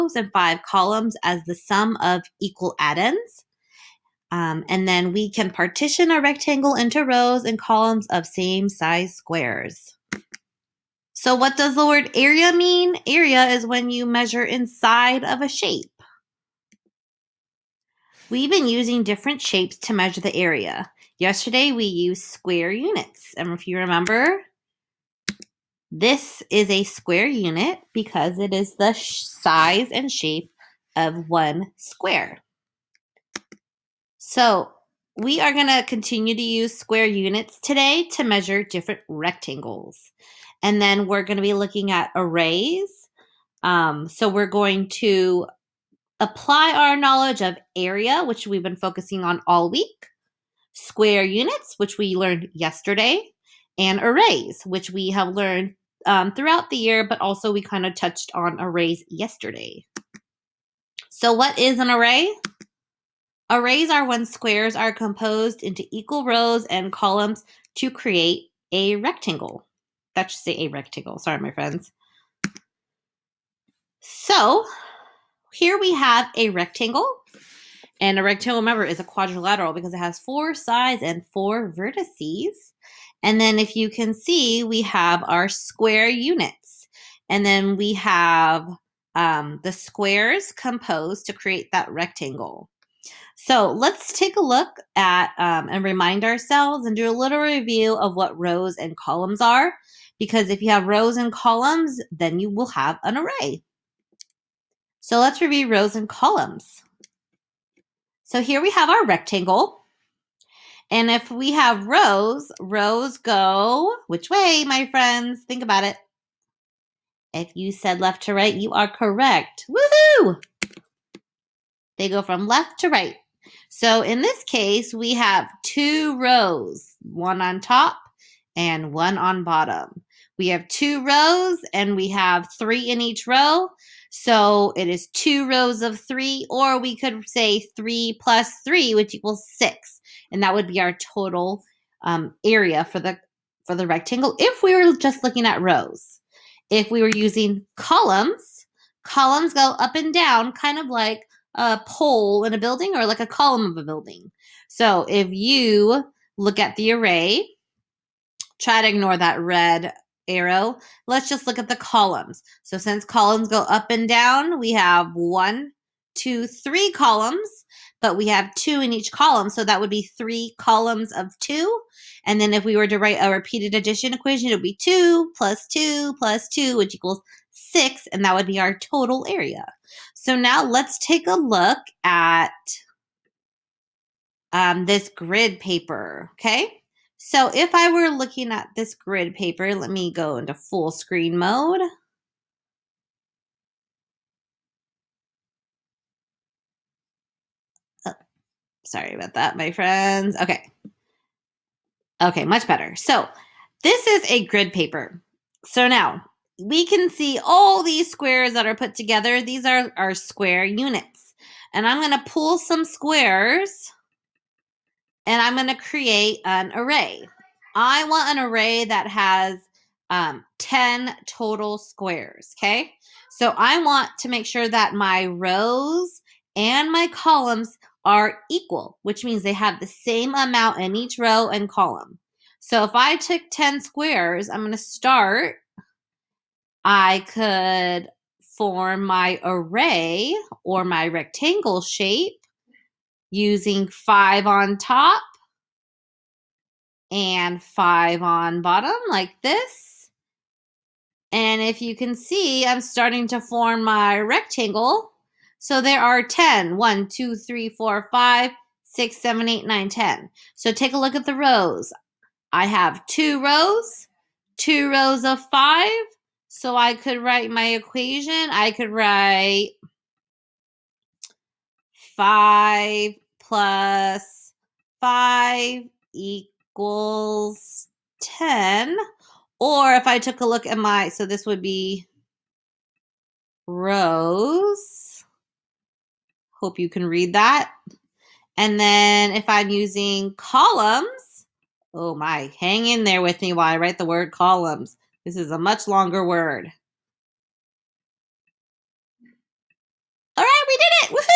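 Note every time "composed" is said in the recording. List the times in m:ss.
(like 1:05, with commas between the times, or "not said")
1:04, 1:30.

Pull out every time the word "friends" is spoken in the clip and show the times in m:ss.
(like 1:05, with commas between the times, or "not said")
1:11, 1:54, 3:19.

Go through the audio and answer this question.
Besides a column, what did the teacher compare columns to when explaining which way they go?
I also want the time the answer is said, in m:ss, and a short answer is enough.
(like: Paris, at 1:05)
a pole, at 2:31.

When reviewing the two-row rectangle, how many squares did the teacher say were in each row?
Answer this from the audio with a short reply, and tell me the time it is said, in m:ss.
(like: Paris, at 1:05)
3, at 2:11.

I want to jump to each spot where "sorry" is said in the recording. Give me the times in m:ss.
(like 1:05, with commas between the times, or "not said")
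1:11, 3:18.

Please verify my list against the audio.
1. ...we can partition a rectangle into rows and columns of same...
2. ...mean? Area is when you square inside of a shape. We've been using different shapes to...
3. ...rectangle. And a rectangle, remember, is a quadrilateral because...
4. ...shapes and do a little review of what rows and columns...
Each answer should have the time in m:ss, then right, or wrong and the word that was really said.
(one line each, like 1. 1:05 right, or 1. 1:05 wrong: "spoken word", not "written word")
1. 0:05 right
2. 0:12 wrong: "measure", not "square"
3. 1:16 right
4. 1:36 wrong: "ourselves", not "shapes".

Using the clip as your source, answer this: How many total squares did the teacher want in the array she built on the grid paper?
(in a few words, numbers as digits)
10.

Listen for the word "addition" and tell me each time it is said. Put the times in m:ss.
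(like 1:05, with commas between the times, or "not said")
2:53.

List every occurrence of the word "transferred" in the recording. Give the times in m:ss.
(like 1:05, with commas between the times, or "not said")
not said.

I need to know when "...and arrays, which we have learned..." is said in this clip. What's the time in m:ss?
0:53.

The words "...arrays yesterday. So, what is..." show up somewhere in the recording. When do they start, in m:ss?
0:58.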